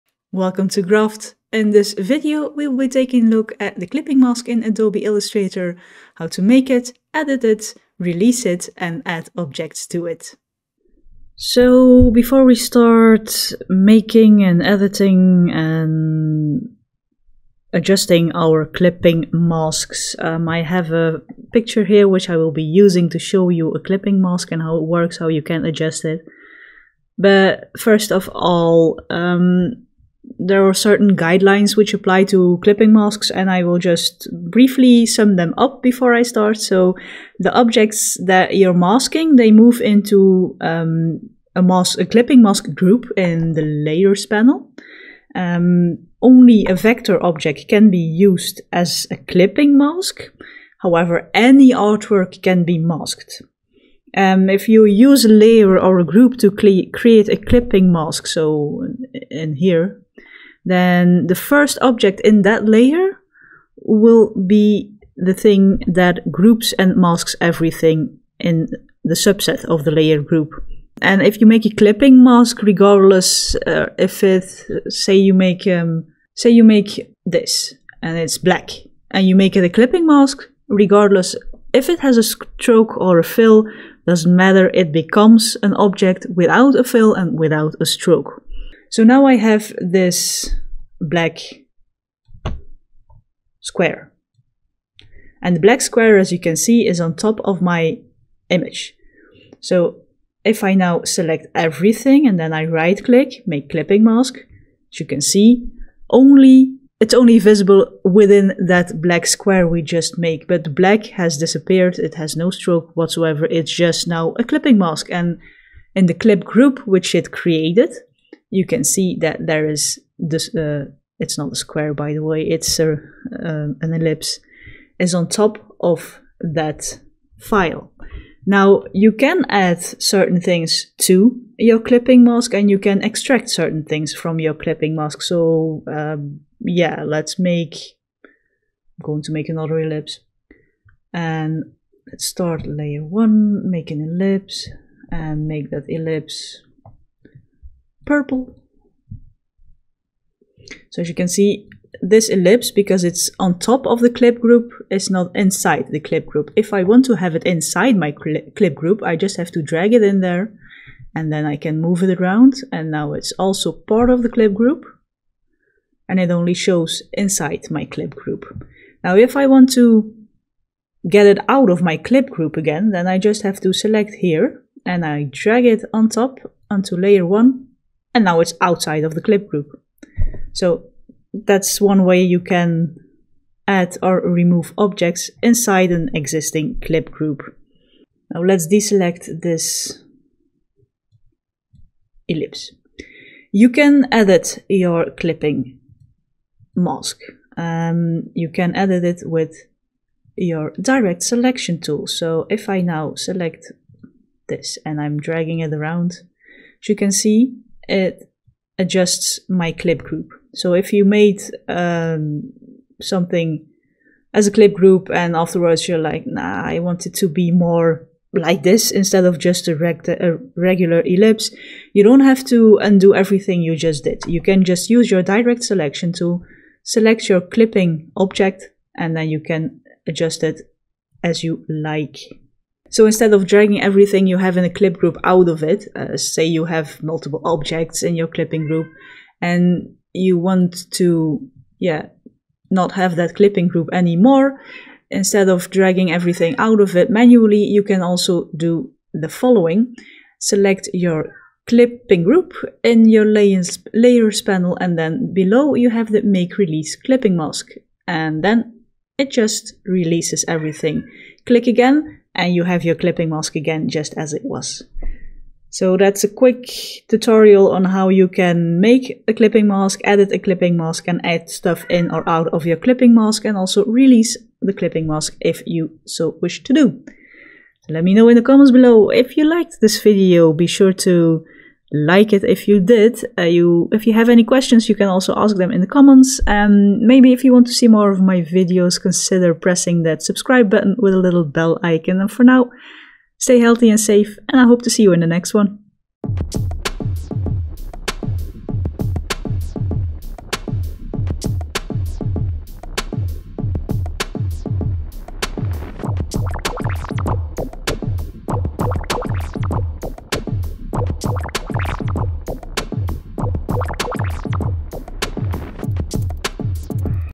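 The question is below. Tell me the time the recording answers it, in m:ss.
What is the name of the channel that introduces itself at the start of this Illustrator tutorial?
0:00.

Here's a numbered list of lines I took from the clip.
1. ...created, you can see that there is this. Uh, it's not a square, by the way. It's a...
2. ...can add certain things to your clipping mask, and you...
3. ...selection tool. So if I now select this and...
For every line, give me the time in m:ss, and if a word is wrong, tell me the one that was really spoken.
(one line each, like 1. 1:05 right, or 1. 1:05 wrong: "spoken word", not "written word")
1. 1:57 right
2. 2:09 right
3. 3:21 right.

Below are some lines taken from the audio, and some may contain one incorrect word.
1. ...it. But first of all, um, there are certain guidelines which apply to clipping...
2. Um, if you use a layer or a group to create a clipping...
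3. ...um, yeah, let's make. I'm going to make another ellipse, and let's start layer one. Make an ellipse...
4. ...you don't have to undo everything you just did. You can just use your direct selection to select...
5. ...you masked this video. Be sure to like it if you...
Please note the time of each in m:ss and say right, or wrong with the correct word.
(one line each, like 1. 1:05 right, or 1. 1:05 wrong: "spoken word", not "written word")
1. 0:26 right
2. 0:54 right
3. 2:15 right
4. 3:41 right
5. 4:39 wrong: "liked", not "masked".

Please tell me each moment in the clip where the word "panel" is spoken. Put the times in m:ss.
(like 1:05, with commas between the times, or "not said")
0:44, 4:14.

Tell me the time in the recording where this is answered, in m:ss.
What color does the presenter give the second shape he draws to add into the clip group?
2:28.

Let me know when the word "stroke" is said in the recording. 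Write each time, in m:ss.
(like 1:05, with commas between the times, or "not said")
1:22, 1:27, 1:52.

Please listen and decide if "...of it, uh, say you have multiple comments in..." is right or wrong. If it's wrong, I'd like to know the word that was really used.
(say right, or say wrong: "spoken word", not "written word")
wrong: "objects", not "comments".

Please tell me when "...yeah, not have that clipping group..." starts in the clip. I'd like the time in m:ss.
4:01.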